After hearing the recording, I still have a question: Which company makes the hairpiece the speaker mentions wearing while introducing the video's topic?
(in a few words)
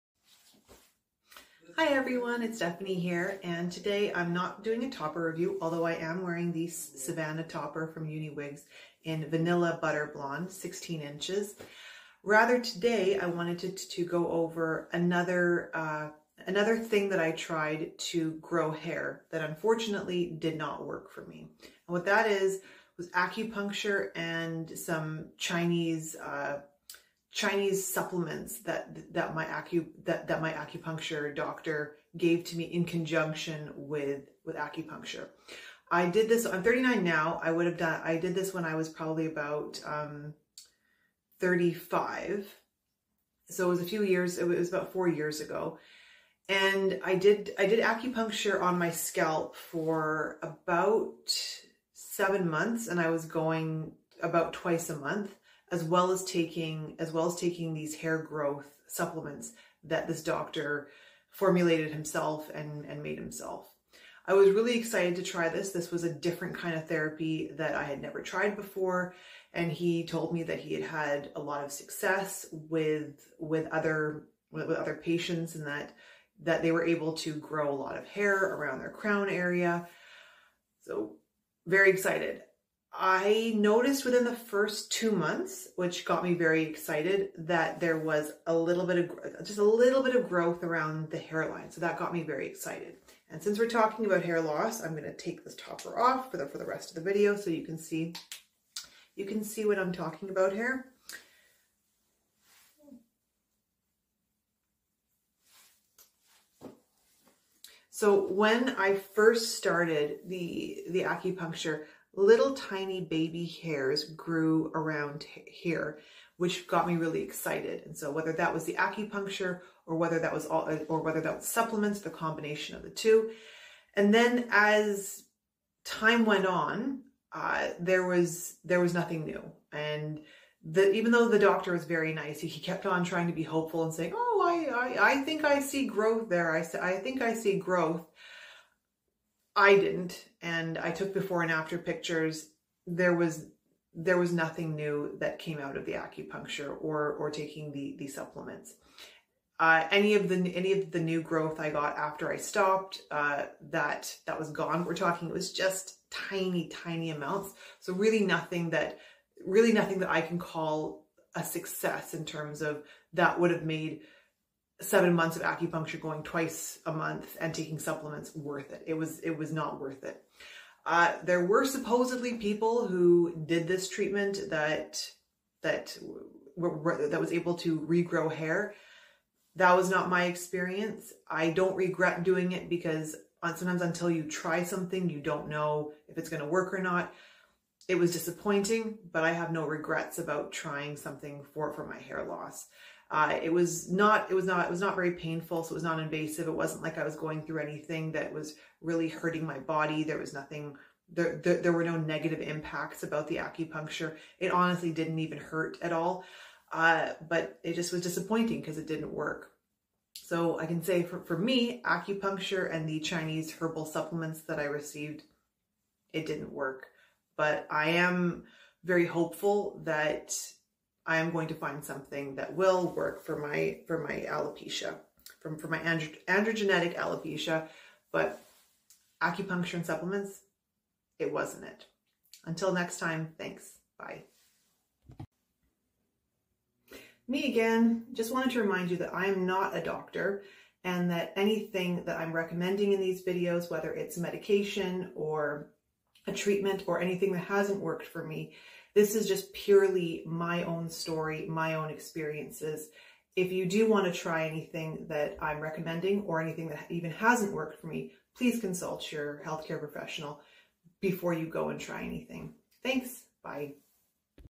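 Uniwigs.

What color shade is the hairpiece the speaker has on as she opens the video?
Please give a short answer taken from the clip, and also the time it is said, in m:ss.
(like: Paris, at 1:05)
Vanilla Butter Blonde, at 0:09.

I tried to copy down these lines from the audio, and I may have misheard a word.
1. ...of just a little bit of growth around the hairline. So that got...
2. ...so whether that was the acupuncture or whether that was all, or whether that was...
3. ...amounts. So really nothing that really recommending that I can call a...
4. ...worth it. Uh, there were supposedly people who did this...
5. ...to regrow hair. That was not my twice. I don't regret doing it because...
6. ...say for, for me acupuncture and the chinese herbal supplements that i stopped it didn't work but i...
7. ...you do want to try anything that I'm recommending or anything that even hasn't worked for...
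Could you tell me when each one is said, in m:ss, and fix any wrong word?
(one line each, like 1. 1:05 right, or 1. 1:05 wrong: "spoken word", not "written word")
1. 1:29 right
2. 1:57 right
3. 2:37 wrong: "nothing", not "recommending"
4. 2:49 right
5. 2:57 wrong: "experience", not "twice"
6. 3:30 wrong: "received", not "stopped"
7. 4:13 right.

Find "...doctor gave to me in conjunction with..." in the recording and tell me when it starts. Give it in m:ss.
0:31.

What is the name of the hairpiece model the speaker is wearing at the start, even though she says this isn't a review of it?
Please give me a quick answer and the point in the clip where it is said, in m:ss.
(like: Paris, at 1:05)
Savannah, at 0:06.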